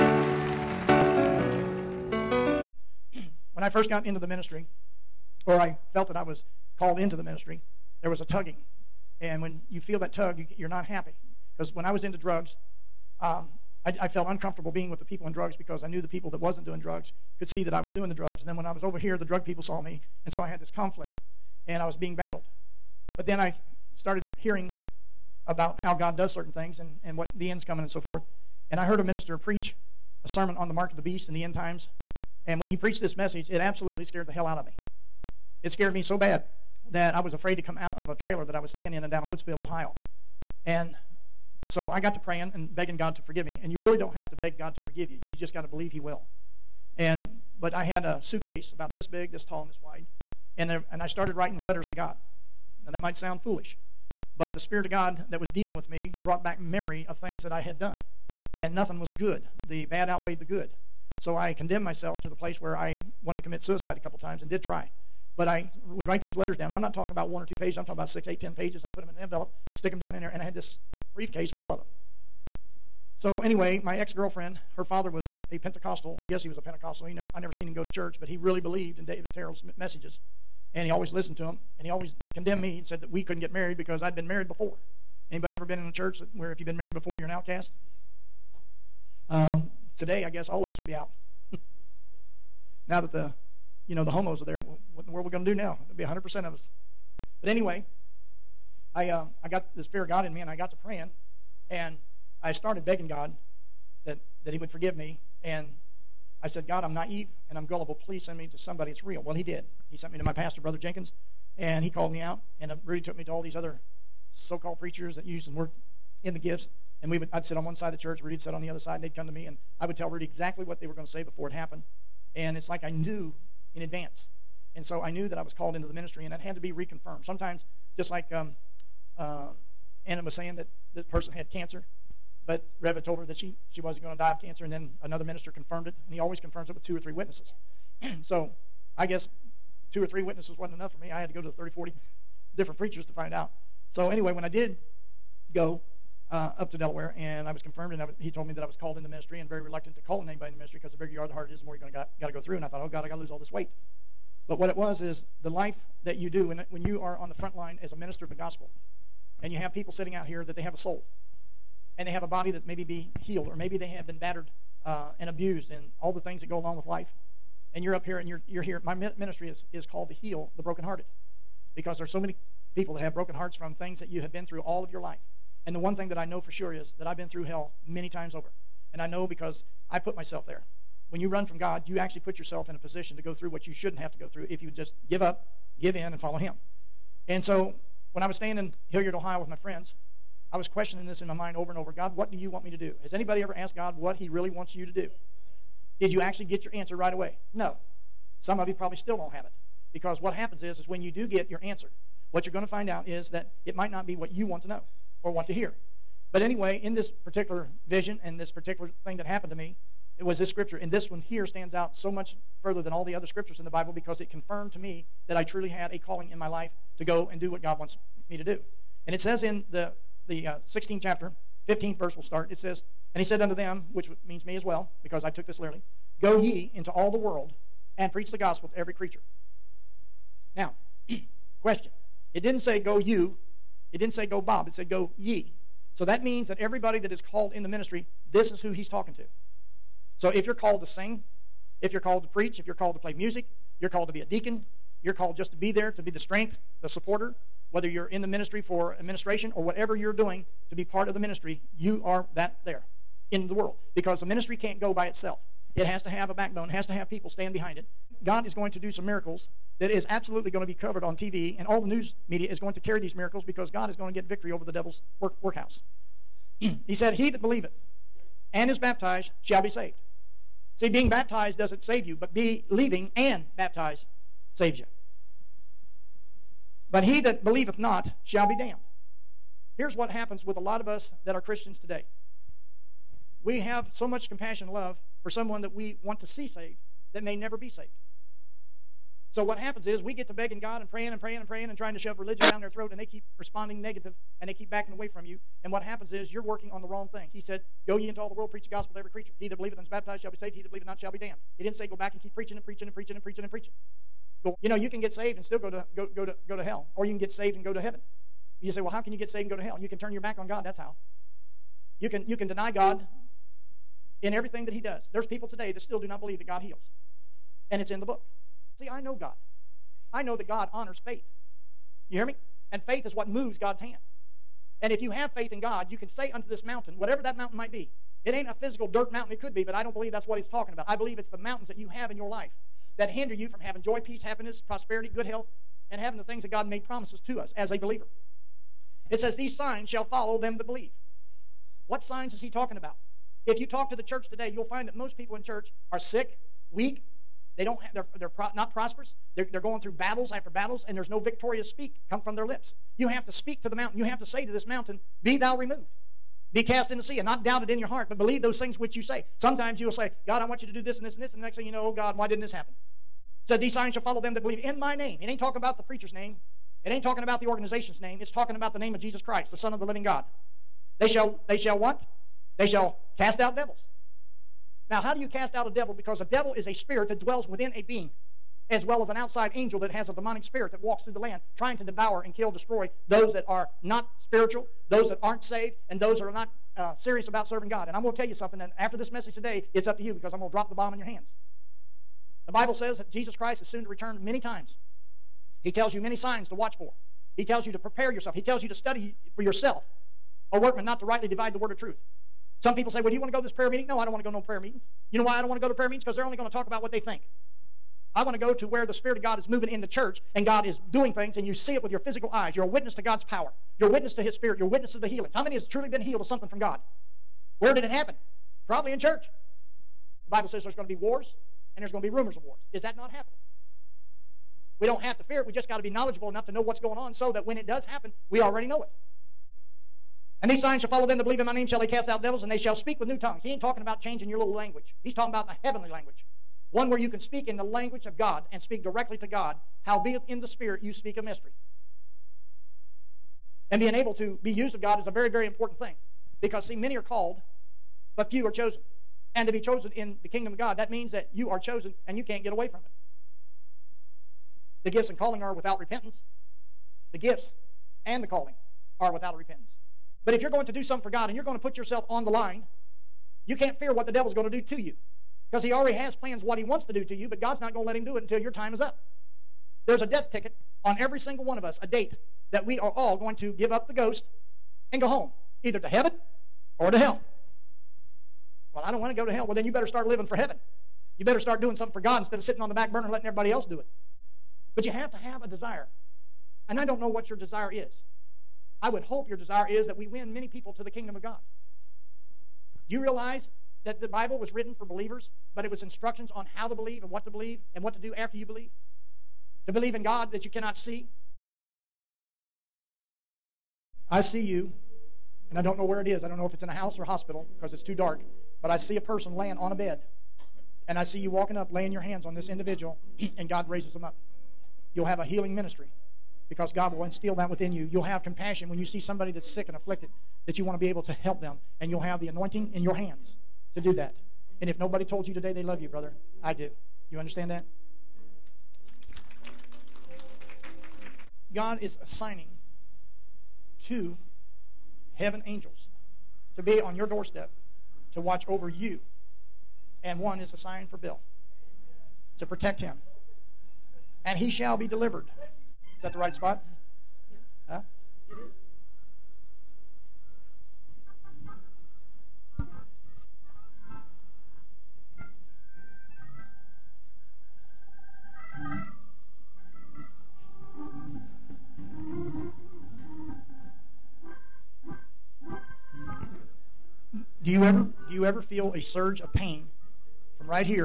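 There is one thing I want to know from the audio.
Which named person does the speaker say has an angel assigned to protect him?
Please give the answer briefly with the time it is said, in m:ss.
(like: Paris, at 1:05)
Bill, at 9:00.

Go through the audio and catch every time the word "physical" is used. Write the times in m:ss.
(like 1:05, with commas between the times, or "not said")
5:28, 6:51.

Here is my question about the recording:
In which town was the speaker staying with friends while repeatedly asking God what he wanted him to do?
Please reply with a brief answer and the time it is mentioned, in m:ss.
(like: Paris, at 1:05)
Hilliard, Ohio, at 3:08.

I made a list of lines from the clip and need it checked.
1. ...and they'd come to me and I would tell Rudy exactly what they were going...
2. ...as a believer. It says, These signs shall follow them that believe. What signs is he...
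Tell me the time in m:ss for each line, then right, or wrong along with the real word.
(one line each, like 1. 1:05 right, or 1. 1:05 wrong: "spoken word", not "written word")
1. 1:58 right
2. 5:37 right.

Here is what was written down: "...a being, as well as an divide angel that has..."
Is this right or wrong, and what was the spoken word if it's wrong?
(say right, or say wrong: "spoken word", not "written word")
wrong: "outside", not "divide".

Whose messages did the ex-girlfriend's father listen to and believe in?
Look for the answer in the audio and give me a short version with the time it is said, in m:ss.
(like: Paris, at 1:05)
David Terrell, at 1:19.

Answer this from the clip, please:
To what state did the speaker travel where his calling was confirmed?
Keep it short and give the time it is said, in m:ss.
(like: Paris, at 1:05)
Delaware, at 2:26.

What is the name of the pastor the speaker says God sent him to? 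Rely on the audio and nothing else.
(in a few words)
Brother Jenkins.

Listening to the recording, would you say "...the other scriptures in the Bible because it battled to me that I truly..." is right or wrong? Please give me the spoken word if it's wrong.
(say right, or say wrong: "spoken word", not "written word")
wrong: "confirmed", not "battled".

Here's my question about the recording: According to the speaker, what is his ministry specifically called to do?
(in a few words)
heal the brokenhearted.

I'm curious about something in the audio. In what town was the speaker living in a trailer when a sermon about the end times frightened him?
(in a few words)
Woodsfield, Ohio.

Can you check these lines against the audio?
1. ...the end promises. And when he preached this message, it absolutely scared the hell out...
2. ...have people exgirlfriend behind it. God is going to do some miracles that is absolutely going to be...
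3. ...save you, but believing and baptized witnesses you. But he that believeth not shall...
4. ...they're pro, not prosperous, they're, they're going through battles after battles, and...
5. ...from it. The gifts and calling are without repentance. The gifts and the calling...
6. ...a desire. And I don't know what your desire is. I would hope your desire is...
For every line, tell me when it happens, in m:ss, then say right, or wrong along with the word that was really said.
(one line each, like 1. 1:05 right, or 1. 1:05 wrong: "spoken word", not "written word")
1. 0:31 wrong: "times", not "promises"
2. 4:16 wrong: "stand", not "exgirlfriend"
3. 4:31 wrong: "saves", not "witnesses"
4. 5:48 right
5. 7:32 right
6. 8:05 right.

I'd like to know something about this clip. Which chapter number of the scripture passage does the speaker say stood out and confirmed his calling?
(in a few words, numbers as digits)
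16.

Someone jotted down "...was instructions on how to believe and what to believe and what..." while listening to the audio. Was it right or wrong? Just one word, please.
right.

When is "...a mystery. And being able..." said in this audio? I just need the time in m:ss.
7:21.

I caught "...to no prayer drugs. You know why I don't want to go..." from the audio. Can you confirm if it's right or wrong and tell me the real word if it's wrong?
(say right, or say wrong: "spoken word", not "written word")
wrong: "meetings", not "drugs".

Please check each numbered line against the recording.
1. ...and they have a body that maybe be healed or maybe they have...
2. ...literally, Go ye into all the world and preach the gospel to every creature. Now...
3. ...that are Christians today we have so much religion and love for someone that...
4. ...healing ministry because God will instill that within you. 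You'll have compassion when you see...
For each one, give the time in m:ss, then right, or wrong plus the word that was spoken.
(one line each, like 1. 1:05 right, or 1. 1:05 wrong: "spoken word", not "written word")
1. 2:41 right
2. 3:45 right
3. 4:41 wrong: "compassion", not "religion"
4. 8:35 right.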